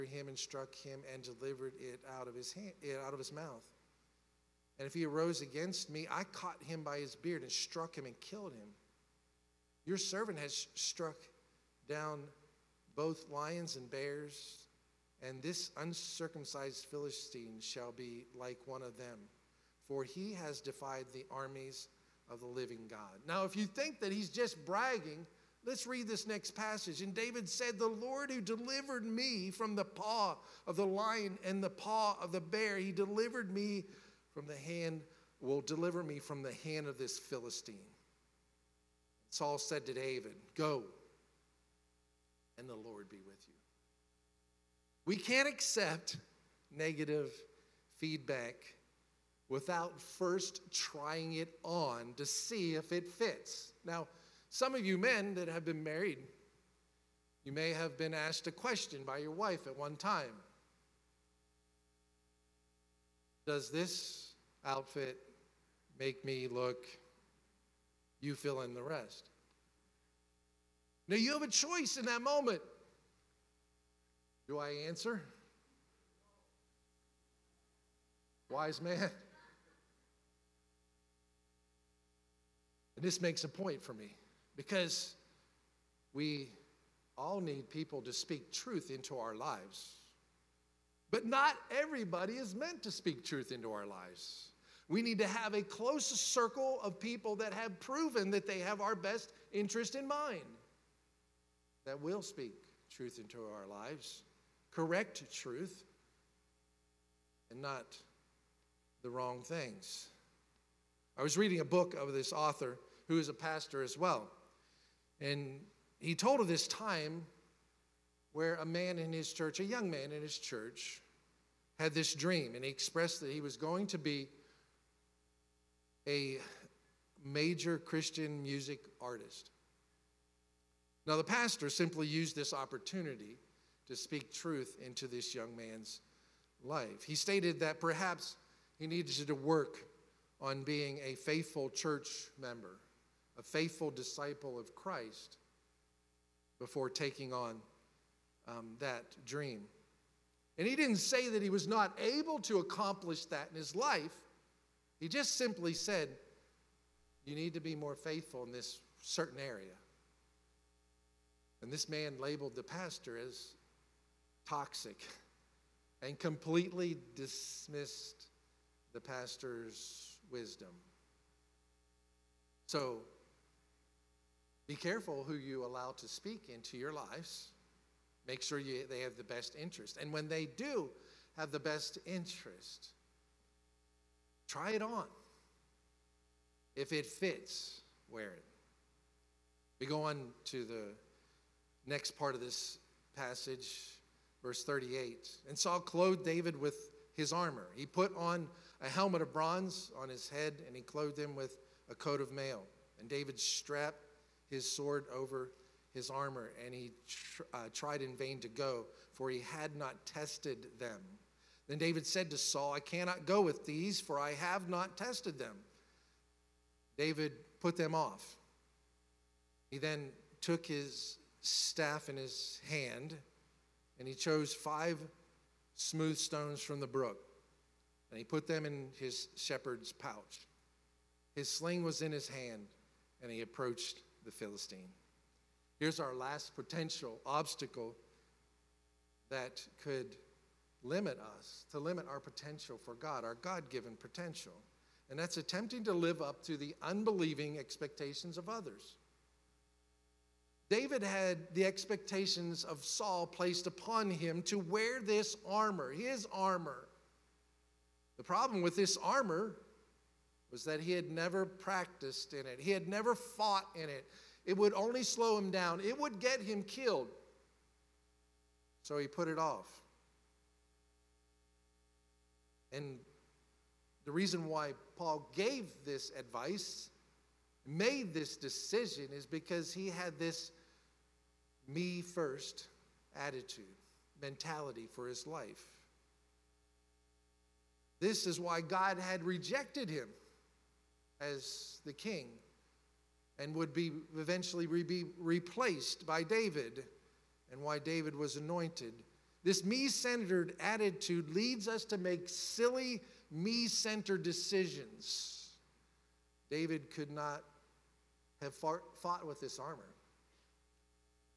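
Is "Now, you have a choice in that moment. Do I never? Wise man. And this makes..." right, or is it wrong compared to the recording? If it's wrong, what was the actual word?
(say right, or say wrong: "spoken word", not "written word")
wrong: "answer", not "never".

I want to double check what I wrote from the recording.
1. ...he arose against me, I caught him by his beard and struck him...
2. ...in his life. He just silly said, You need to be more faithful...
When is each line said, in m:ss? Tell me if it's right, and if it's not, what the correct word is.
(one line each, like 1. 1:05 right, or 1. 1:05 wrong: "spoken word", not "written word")
1. 0:04 right
2. 2:33 wrong: "simply", not "silly".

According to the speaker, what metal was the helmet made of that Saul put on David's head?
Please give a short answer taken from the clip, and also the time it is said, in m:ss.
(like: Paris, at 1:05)
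Bronze, at 3:19.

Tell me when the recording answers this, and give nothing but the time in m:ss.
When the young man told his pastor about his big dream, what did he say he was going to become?
2:07.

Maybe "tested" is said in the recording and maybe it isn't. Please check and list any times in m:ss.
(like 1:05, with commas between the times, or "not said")
3:30, 3:34.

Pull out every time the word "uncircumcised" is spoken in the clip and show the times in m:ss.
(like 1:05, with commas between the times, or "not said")
0:15.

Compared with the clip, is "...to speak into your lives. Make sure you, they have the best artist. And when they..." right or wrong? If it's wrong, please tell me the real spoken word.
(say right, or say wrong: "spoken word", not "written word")
wrong: "interest", not "artist".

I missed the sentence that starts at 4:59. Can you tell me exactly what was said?
This me centered attitude leads us to make silly, me centered decisions.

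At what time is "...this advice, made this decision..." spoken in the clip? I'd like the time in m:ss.
4:35.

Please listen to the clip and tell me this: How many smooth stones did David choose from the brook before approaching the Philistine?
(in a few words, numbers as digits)
5.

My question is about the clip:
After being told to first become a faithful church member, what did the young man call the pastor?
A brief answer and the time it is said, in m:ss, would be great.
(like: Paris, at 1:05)
Toxic, at 2:44.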